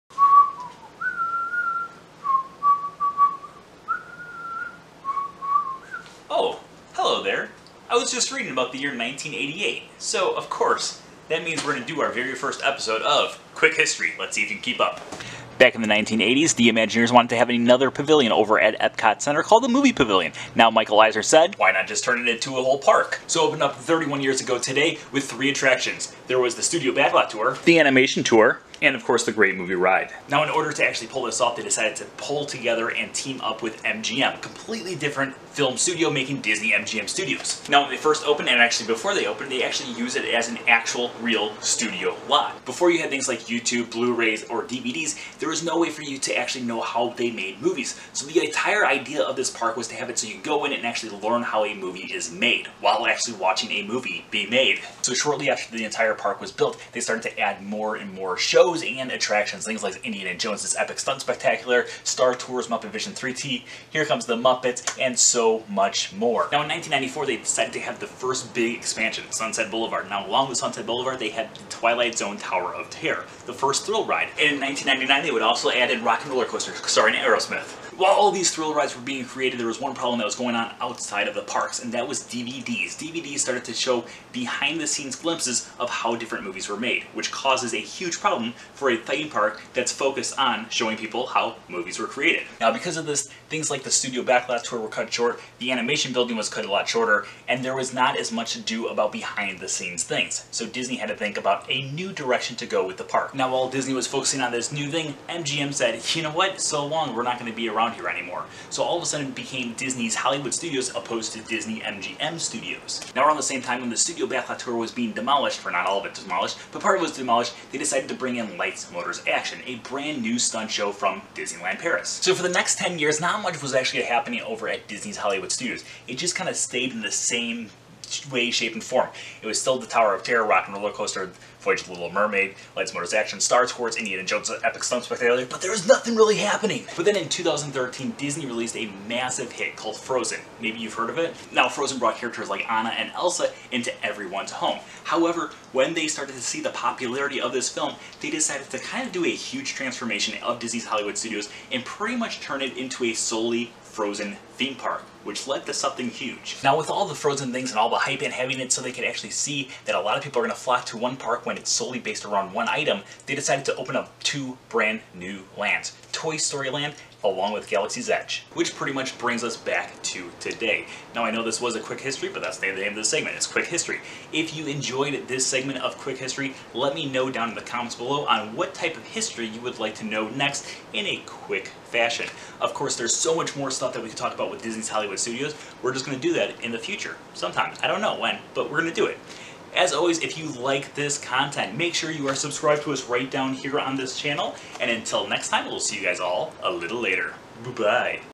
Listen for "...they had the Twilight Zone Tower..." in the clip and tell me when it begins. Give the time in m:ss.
1:11.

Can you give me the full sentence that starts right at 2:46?
Toy Story Land along with Galaxy's Edge, which pretty much brings us back to today.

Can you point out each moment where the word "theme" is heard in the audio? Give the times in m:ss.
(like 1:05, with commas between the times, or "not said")
1:28, 2:34.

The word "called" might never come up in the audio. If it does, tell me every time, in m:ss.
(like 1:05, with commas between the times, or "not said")
0:19, 2:19.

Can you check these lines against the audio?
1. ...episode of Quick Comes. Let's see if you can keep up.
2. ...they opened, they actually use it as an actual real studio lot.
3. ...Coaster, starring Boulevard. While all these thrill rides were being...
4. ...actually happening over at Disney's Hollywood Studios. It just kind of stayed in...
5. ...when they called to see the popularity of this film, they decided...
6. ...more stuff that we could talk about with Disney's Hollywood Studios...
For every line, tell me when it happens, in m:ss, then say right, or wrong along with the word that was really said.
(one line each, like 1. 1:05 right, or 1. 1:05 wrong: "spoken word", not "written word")
1. 0:12 wrong: "History", not "Comes"
2. 0:39 right
3. 1:16 wrong: "Aerosmith", not "Boulevard"
4. 2:03 right
5. 2:25 wrong: "started", not "called"
6. 3:03 right.